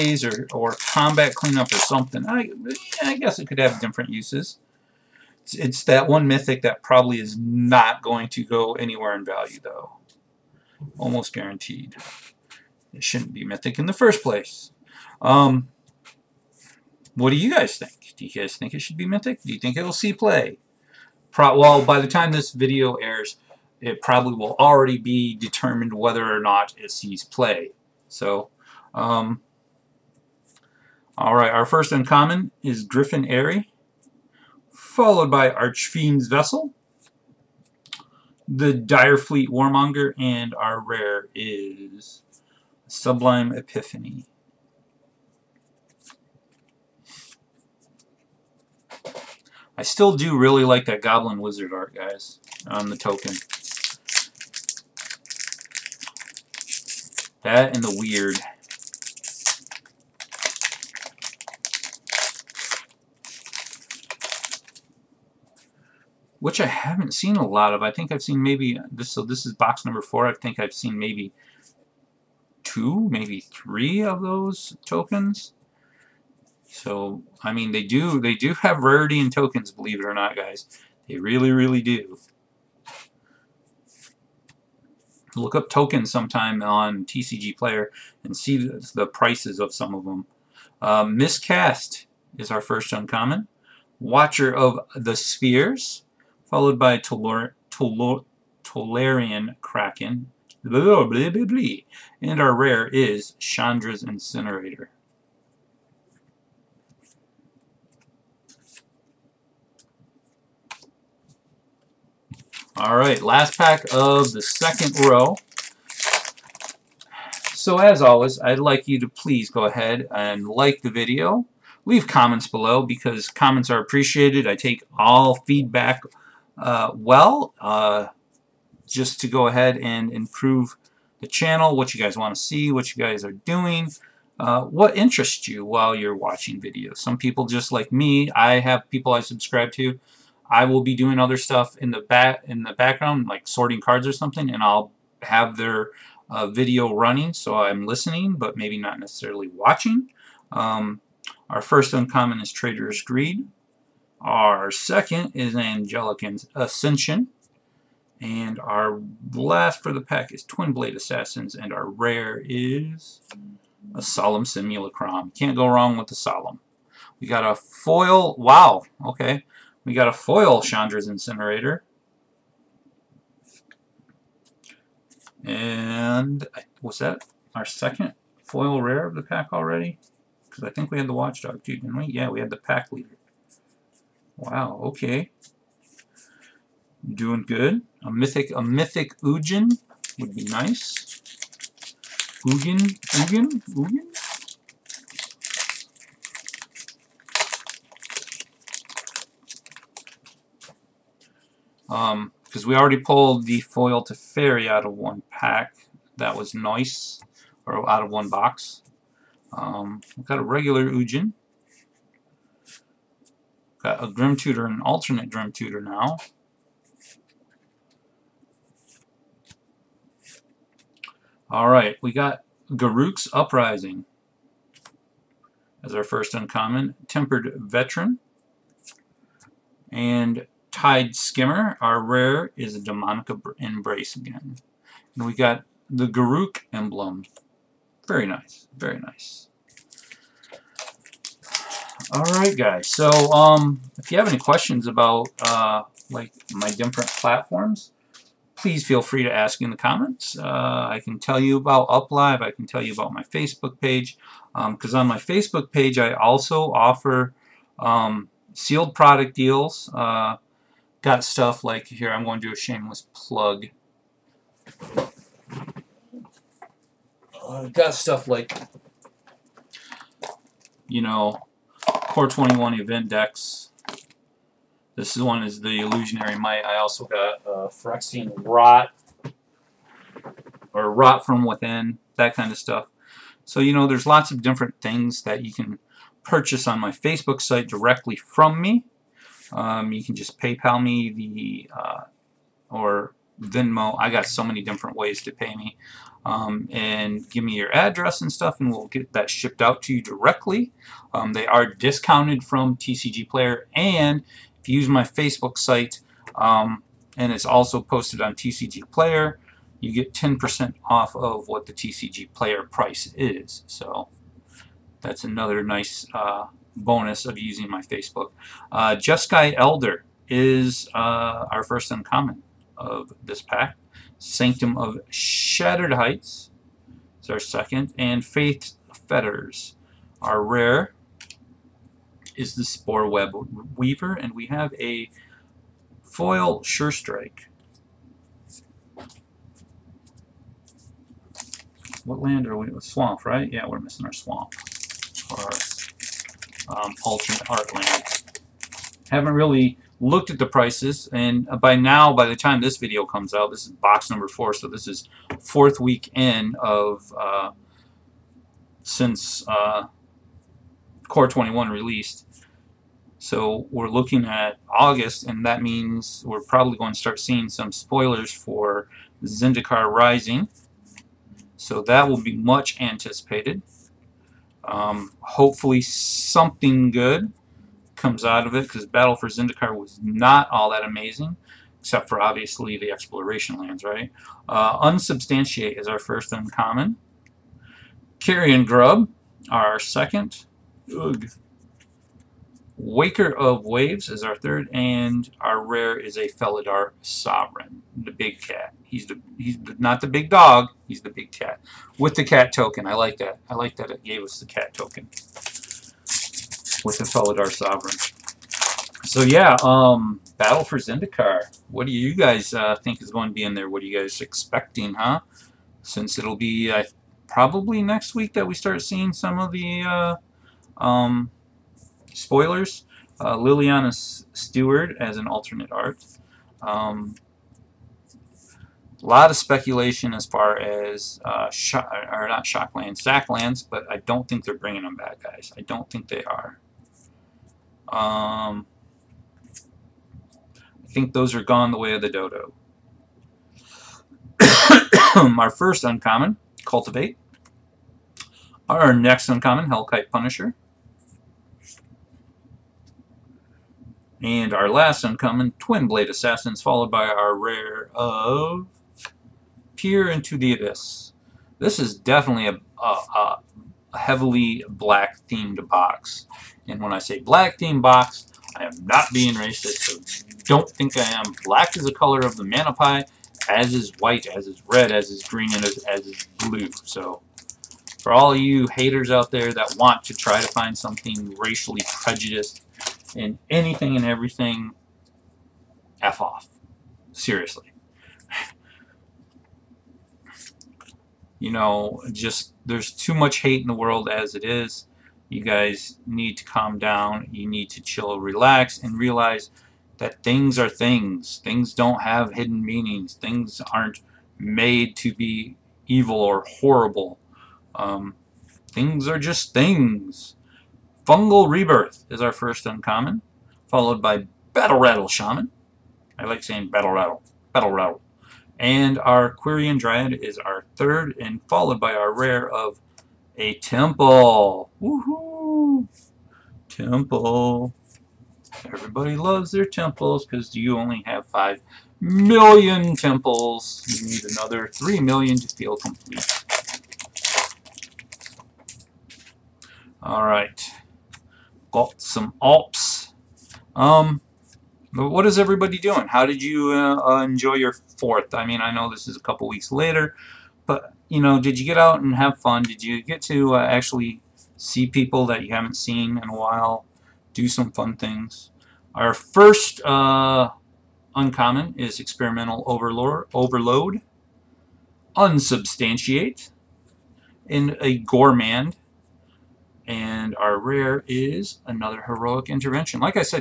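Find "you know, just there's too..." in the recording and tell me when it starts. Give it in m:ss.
8:11.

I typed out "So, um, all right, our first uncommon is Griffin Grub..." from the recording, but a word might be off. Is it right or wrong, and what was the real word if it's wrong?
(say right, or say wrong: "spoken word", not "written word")
wrong: "Aerie", not "Grub".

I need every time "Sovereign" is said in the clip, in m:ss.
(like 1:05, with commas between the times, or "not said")
6:37, 6:47.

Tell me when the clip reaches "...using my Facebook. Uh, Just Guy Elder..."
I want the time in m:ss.
5:17.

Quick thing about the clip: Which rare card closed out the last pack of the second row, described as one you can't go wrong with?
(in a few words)
Solemn Simulacrum.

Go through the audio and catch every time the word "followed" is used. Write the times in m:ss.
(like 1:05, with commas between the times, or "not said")
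0:34, 1:36, 7:36, 8:33, 8:41.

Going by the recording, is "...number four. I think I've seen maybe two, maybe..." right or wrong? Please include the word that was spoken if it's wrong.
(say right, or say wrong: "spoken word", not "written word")
right.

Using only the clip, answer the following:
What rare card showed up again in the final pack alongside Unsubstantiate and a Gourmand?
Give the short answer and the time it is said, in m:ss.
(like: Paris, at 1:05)
Heroic Intervention, at 9:32.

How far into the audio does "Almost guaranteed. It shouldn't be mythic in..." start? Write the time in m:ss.
0:10.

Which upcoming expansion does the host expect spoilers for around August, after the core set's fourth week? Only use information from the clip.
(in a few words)
Zendikar Rising.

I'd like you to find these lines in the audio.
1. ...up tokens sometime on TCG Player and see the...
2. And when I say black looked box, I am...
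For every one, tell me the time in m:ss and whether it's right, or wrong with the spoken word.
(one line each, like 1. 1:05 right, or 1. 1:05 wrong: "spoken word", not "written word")
1. 1:25 right
2. 7:46 wrong: "themed", not "looked".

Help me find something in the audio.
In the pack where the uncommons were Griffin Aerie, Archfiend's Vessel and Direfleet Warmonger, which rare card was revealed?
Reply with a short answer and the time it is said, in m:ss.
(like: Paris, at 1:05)
Sublime Epiphany, at 0:42.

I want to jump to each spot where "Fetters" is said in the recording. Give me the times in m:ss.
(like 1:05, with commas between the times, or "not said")
5:29.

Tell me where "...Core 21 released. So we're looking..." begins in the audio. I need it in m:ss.
6:01.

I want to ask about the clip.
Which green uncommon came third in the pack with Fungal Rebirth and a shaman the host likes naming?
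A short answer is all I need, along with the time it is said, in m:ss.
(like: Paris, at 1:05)
Quirion Dryad, at 8:39.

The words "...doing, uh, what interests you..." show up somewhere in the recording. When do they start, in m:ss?
2:13.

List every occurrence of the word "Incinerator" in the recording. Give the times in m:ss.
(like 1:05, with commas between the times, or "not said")
1:44, 2:51.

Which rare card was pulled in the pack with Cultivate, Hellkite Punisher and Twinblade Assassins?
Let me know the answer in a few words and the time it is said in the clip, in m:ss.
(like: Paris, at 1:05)
Peer into the Abyss, at 7:39.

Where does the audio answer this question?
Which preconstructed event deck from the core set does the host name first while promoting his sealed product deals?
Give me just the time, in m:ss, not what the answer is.
4:35.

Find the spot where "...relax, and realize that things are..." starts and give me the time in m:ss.
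8:18.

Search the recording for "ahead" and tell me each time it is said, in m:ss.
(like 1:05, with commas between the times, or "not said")
1:59, 2:09.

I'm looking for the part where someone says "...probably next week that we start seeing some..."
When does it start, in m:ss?
6:57.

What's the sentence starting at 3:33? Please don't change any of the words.
Got a Grim Tutor and an alternate Grim Tutor now.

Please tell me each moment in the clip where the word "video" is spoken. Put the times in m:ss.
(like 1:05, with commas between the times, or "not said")
0:22, 2:00, 2:16, 2:26, 5:52.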